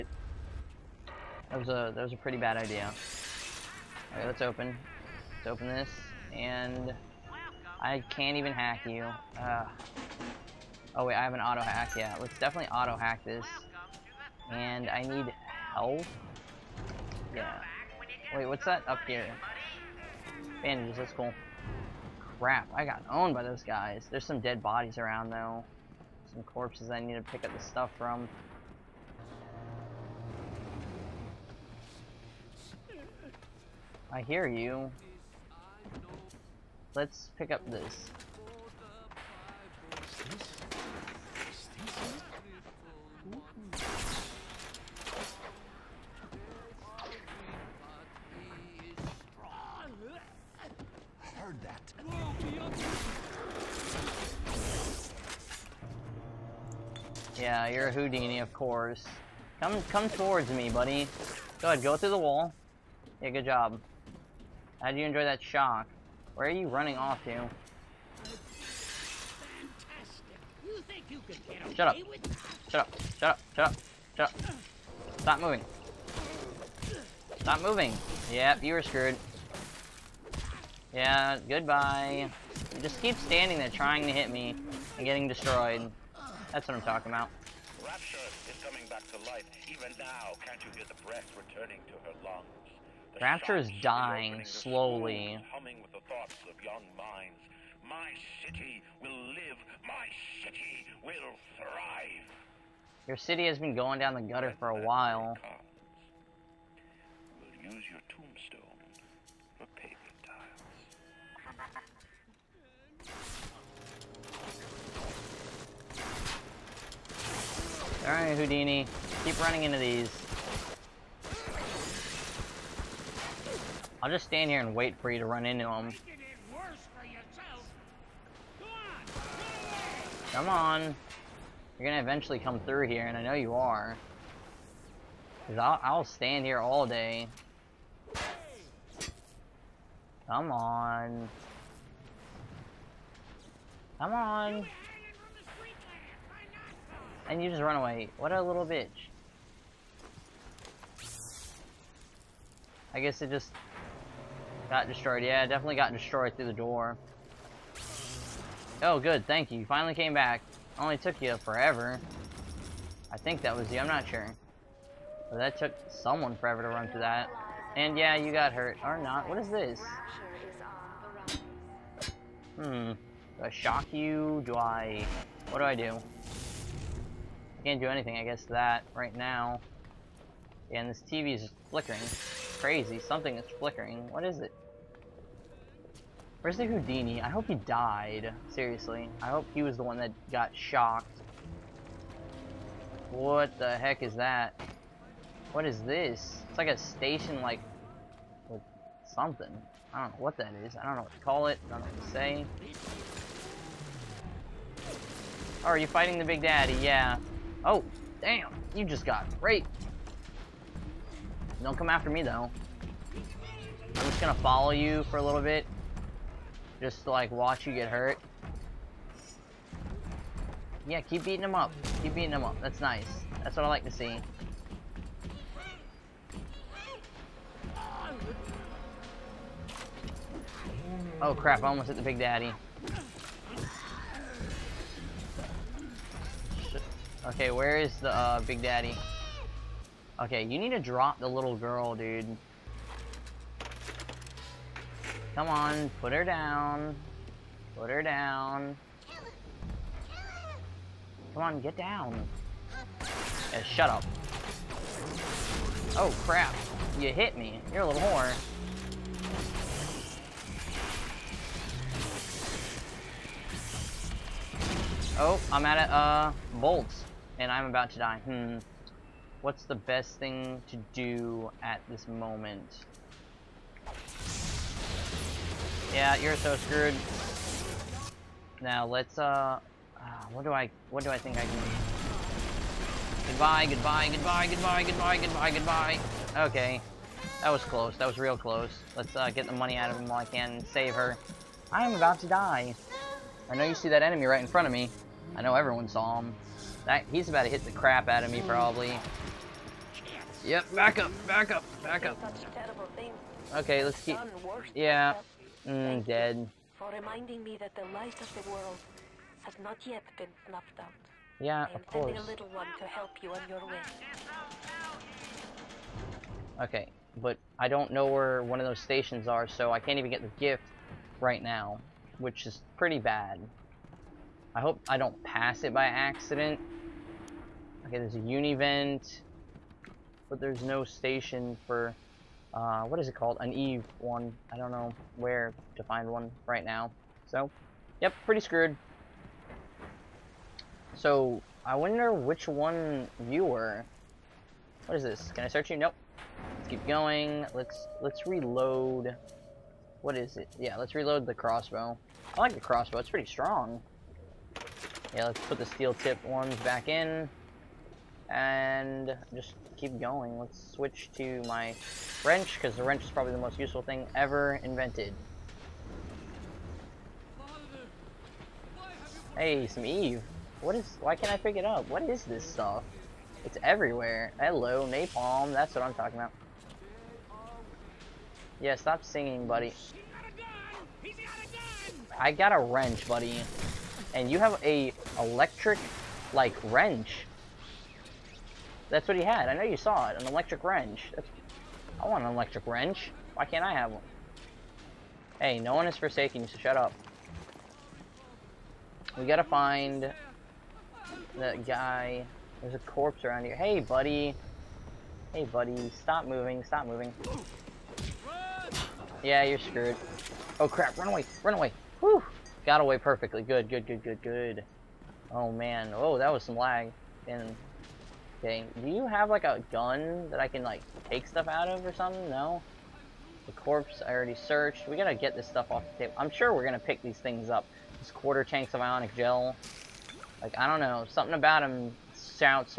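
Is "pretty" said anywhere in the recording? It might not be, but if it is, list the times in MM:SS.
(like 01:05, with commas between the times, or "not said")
00:02, 05:22, 05:38, 05:53.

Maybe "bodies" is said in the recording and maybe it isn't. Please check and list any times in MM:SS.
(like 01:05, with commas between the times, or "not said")
00:24.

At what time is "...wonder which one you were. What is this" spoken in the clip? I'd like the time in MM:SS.
05:41.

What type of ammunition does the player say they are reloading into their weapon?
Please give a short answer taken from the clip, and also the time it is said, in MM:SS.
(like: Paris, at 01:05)
steel tip, at 05:55.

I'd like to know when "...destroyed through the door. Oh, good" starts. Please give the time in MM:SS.
02:35.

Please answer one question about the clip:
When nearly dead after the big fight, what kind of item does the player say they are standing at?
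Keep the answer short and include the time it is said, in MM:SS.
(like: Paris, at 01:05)
bolts, at 04:26.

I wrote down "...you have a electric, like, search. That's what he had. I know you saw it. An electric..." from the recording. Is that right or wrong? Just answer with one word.
wrong.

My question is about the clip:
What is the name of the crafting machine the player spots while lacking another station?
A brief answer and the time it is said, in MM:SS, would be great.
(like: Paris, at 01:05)
U-Invent, at 05:28.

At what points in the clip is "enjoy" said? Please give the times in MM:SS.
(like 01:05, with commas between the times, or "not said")
01:05.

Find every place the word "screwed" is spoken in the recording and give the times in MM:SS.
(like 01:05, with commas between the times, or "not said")
01:18, 04:36, 05:38, 06:49.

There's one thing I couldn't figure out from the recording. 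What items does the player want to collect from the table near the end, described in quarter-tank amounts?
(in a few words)
ionic gel.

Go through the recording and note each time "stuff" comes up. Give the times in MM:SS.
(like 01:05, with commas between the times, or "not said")
00:27, 06:12, 07:01, 07:05.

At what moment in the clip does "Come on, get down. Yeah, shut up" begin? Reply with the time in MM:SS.
04:11.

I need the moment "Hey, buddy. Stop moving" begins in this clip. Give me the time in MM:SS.
06:45.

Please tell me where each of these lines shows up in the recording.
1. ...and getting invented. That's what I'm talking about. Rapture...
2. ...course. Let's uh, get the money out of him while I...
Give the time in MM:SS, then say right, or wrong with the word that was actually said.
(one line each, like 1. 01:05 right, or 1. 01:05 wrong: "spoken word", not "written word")
1. 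01:24 wrong: "destroyed", not "invented"
2. 04:48 wrong: "close", not "course".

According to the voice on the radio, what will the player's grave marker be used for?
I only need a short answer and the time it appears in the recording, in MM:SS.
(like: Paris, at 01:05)
paving tiles, at 01:49.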